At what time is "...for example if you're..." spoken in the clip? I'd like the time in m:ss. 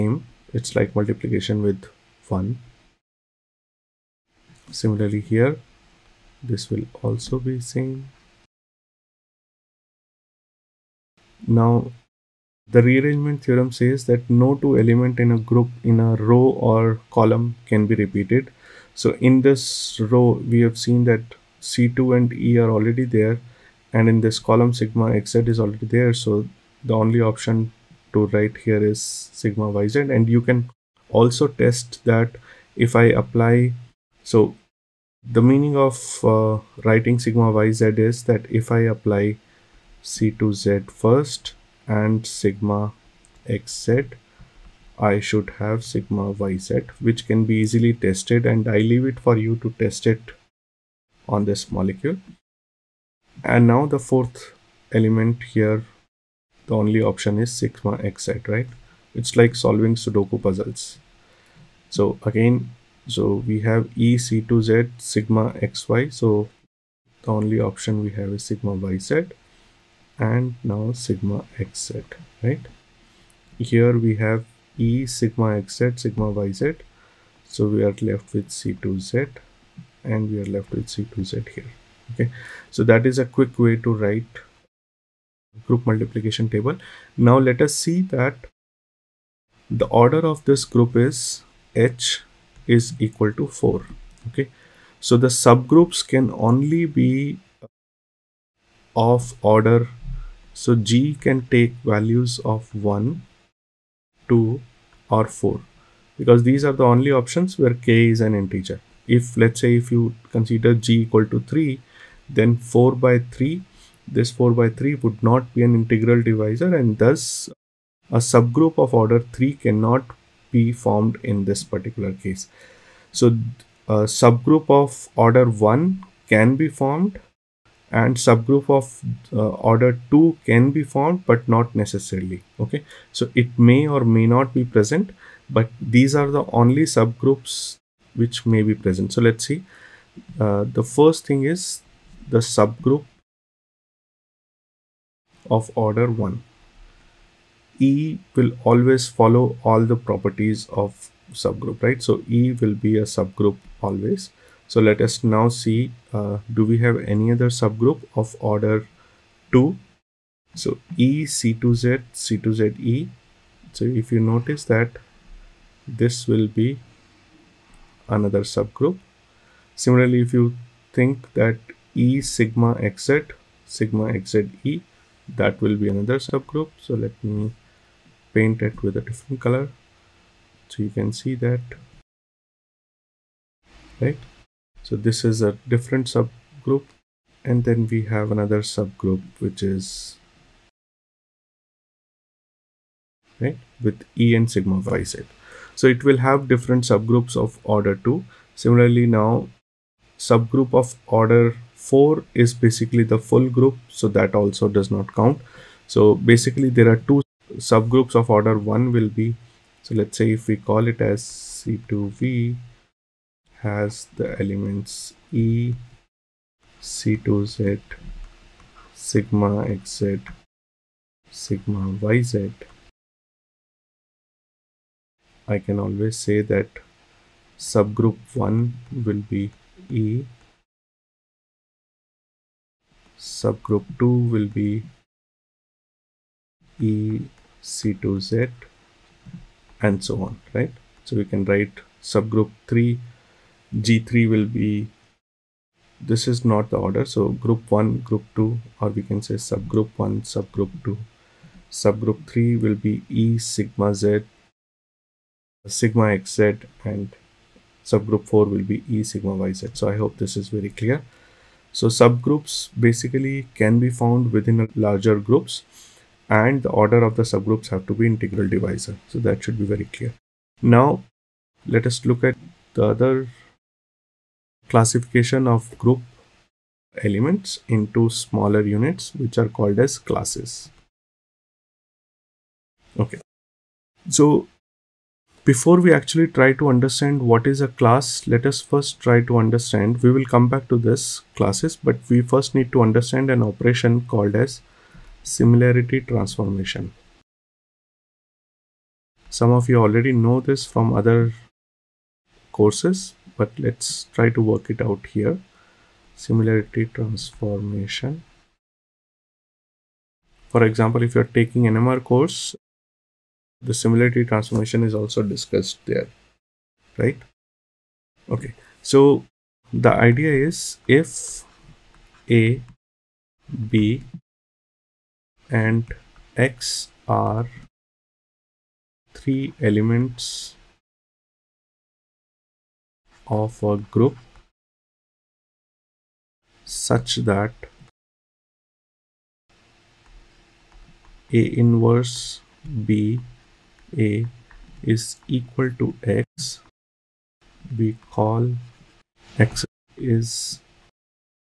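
5:10.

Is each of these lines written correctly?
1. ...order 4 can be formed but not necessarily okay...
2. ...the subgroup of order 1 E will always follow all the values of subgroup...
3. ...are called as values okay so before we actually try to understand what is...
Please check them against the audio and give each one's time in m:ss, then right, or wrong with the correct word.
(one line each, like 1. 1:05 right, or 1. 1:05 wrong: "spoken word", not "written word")
1. 2:09 wrong: "2", not "4"
2. 2:22 wrong: "properties", not "values"
3. 4:39 wrong: "classes", not "values".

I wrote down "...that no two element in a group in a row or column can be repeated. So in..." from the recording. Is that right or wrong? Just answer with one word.
right.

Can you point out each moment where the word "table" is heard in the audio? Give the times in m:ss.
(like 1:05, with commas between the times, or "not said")
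1:26.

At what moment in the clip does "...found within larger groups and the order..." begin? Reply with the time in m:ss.
4:23.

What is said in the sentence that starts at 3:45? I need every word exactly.
I can always say that subgroup 1 will be E, subgroup 2 will be E, C2Z, and so on, right?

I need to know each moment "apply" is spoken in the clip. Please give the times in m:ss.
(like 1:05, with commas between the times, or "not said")
0:33, 0:38.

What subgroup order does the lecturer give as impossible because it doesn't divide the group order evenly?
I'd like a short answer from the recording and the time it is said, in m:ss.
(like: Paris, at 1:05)
3, at 1:50.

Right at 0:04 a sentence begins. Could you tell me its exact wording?
Similarly here, this will also be same.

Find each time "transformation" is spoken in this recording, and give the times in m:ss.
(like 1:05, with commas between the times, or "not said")
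4:55, 5:06, 5:14.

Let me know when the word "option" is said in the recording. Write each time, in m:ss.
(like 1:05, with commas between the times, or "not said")
0:27, 0:57, 1:07, 1:47.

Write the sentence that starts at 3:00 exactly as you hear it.
So you can see that, right?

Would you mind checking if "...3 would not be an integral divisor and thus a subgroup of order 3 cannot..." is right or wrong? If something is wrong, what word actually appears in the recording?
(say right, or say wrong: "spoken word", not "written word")
right.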